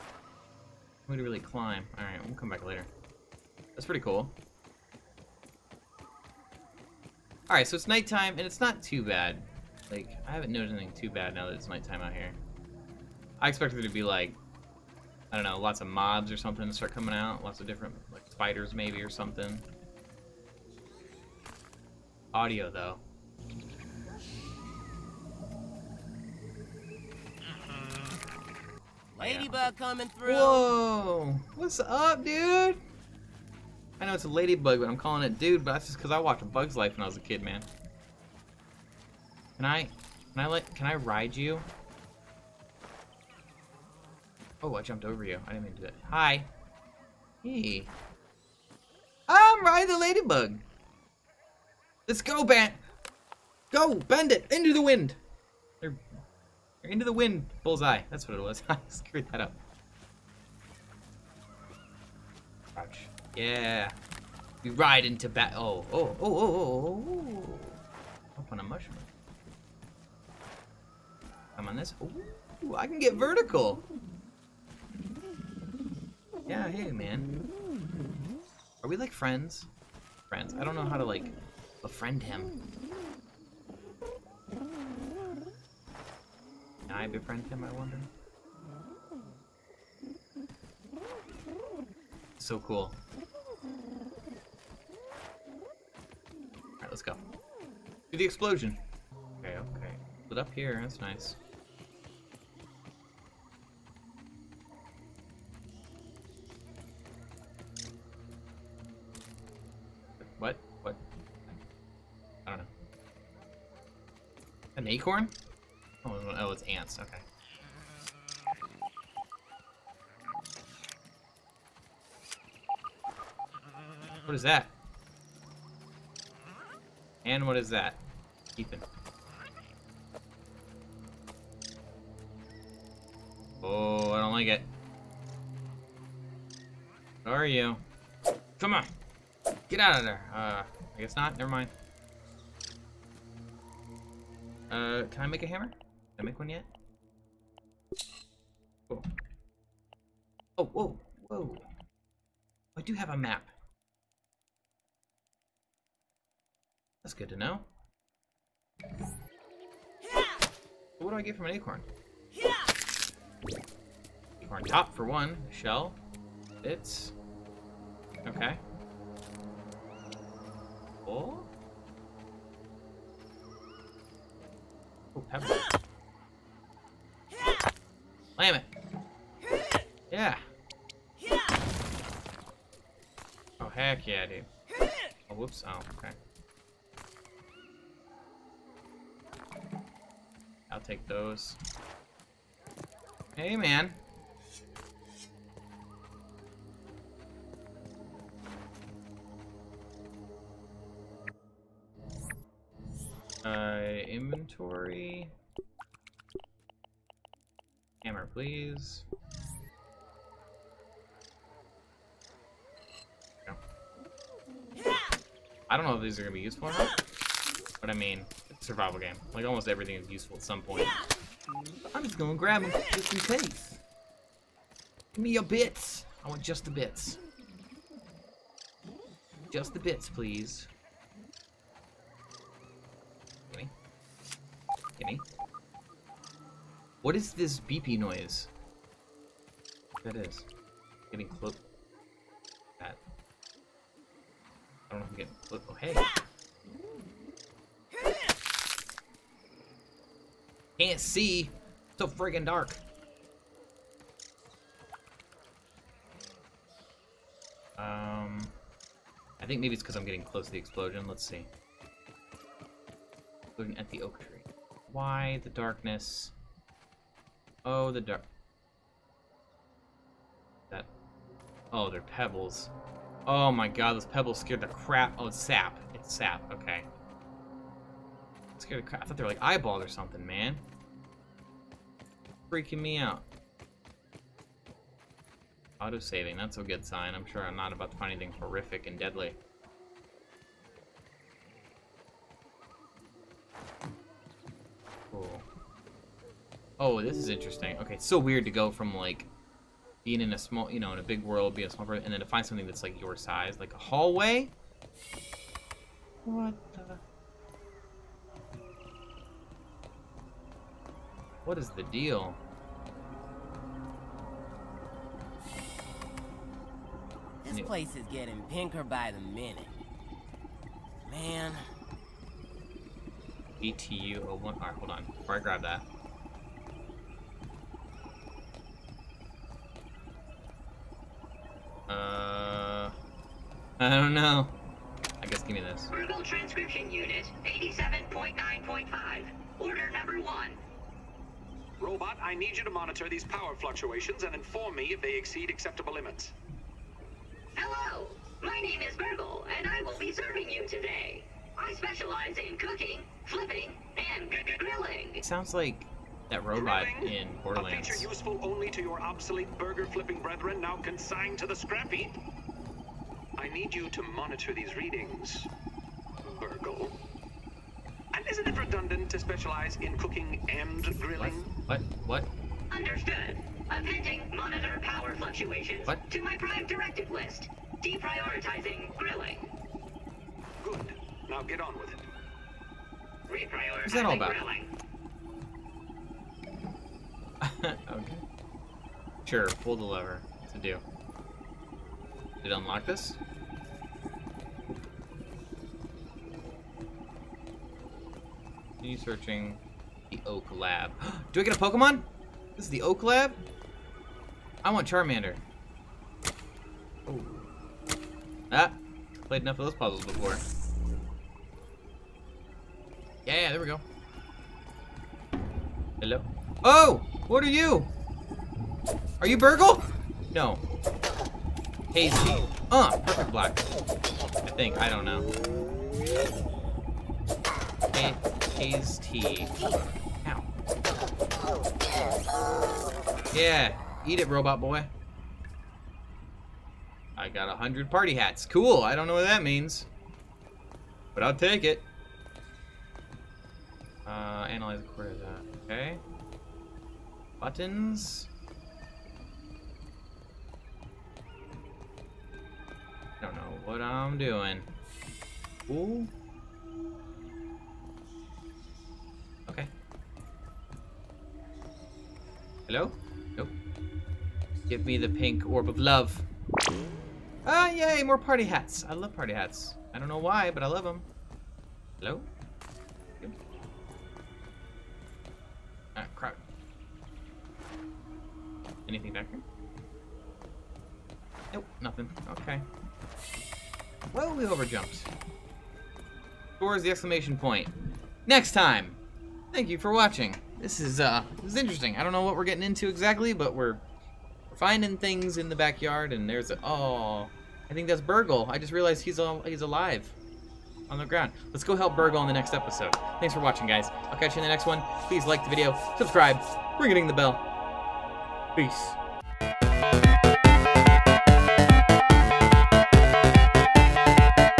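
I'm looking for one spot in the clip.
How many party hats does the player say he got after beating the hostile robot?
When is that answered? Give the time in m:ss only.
7:17.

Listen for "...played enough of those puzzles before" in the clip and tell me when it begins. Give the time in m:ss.
6:49.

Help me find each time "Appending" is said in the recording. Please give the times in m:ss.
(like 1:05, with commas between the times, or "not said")
6:13.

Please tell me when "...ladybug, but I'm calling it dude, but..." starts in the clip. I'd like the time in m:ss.
0:34.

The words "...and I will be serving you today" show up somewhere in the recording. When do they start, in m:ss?
5:49.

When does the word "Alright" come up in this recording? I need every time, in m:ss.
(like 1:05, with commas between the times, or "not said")
0:01, 0:07, 1:36, 5:24.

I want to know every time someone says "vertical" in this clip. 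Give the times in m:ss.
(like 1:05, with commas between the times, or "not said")
1:13.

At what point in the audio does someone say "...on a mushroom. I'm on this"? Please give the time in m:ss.
1:08.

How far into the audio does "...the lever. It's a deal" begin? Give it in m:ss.
6:29.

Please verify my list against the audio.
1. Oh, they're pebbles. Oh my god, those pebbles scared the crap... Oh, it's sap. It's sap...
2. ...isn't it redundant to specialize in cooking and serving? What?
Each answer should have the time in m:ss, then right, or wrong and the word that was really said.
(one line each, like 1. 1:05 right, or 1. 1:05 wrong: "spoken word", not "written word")
1. 4:31 right
2. 6:08 wrong: "grilling", not "serving".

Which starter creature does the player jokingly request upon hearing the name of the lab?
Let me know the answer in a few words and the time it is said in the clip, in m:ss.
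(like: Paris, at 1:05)
Charmander, at 6:44.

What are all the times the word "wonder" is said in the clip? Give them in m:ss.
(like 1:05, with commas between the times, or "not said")
1:27.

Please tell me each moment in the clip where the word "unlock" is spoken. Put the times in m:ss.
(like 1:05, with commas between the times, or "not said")
6:32.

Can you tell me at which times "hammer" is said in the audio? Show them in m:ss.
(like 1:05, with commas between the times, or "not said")
2:25, 3:28.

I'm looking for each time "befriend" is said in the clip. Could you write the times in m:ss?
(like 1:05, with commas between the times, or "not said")
1:21, 1:27.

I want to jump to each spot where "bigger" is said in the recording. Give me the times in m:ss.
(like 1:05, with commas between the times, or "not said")
not said.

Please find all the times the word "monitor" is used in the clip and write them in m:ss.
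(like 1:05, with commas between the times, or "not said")
5:42, 6:04, 6:14.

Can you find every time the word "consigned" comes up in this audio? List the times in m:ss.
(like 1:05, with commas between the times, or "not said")
6:00.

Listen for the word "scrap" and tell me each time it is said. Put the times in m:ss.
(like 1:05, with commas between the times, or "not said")
6:01.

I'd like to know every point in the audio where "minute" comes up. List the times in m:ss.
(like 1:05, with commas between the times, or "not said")
5:19.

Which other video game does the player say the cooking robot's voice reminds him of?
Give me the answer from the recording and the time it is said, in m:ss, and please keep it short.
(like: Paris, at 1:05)
Borderlands, at 5:57.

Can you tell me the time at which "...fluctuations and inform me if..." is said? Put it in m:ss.
5:43.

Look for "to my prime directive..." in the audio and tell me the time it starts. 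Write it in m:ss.
6:16.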